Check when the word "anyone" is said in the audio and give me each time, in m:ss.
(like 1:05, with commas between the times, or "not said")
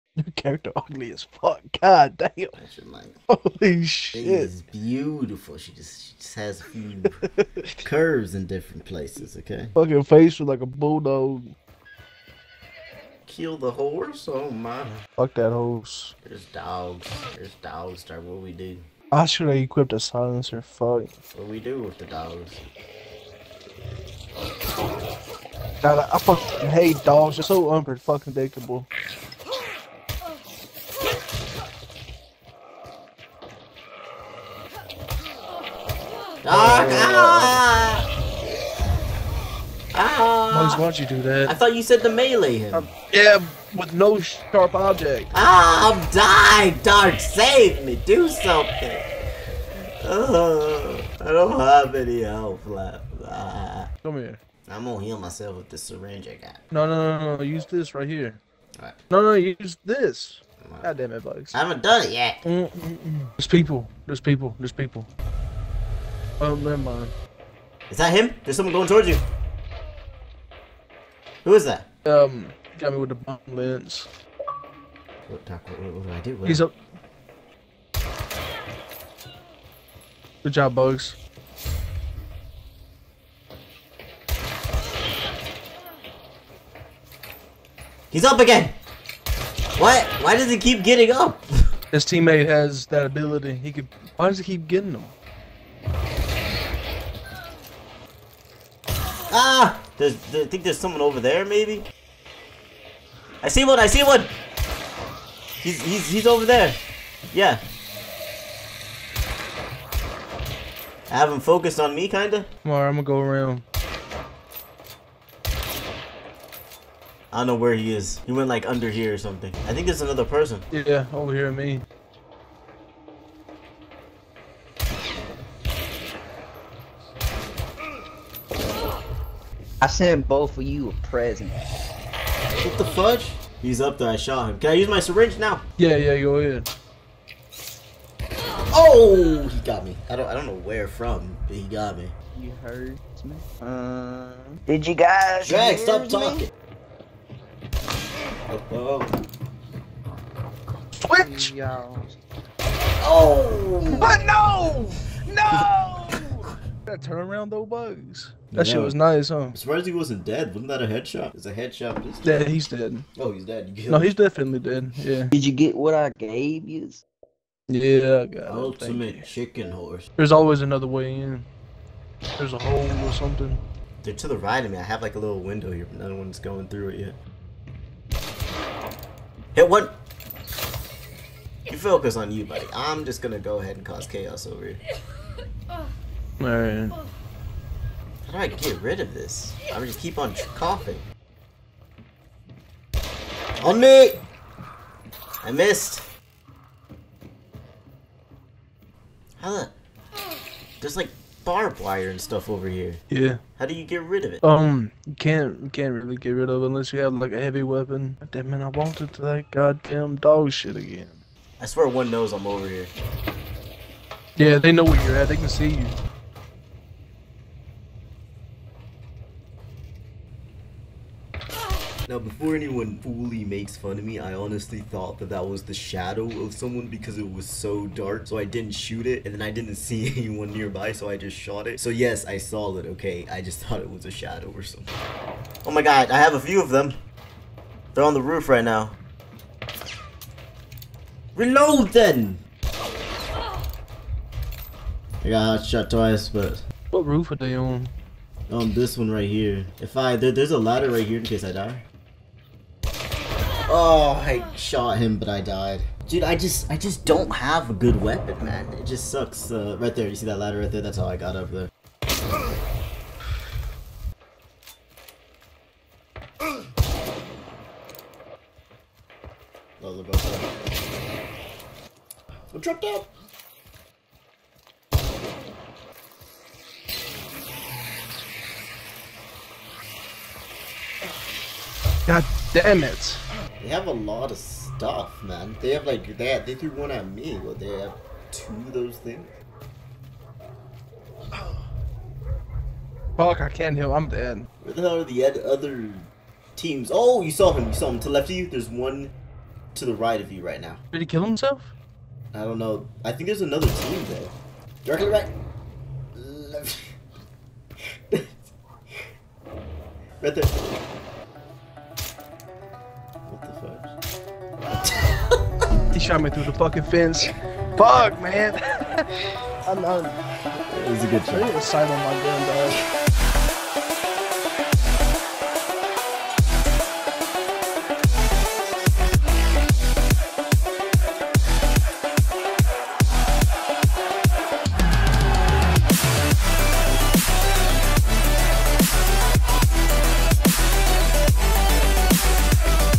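3:42, 3:50.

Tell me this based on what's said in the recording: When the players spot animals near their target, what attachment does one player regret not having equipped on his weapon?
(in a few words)
silencer.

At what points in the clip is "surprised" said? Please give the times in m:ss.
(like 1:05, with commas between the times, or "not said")
2:39.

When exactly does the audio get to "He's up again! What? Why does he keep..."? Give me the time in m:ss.
1:28.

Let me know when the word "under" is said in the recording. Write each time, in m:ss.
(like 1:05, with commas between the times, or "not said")
1:58.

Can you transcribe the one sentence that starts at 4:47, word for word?
Well, they have two of those things.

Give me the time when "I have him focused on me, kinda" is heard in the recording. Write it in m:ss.
1:51.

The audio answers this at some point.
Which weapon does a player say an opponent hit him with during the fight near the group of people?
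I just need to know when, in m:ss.
1:13.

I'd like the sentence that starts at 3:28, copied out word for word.
Damn man, I wanted to that goddamn dog shit again.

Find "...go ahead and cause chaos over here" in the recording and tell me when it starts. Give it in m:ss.
3:03.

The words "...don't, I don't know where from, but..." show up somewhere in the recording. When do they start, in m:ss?
2:20.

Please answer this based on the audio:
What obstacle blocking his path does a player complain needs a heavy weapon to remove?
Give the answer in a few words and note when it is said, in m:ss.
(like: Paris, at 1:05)
barbed wire, at 3:21.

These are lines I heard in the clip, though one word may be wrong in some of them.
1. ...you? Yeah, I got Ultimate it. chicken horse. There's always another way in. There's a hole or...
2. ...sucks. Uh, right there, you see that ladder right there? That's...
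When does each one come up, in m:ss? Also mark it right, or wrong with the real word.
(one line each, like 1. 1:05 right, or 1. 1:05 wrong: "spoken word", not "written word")
1. 2:46 right
2. 4:19 right.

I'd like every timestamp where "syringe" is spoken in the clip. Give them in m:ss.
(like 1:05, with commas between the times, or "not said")
0:55, 2:14.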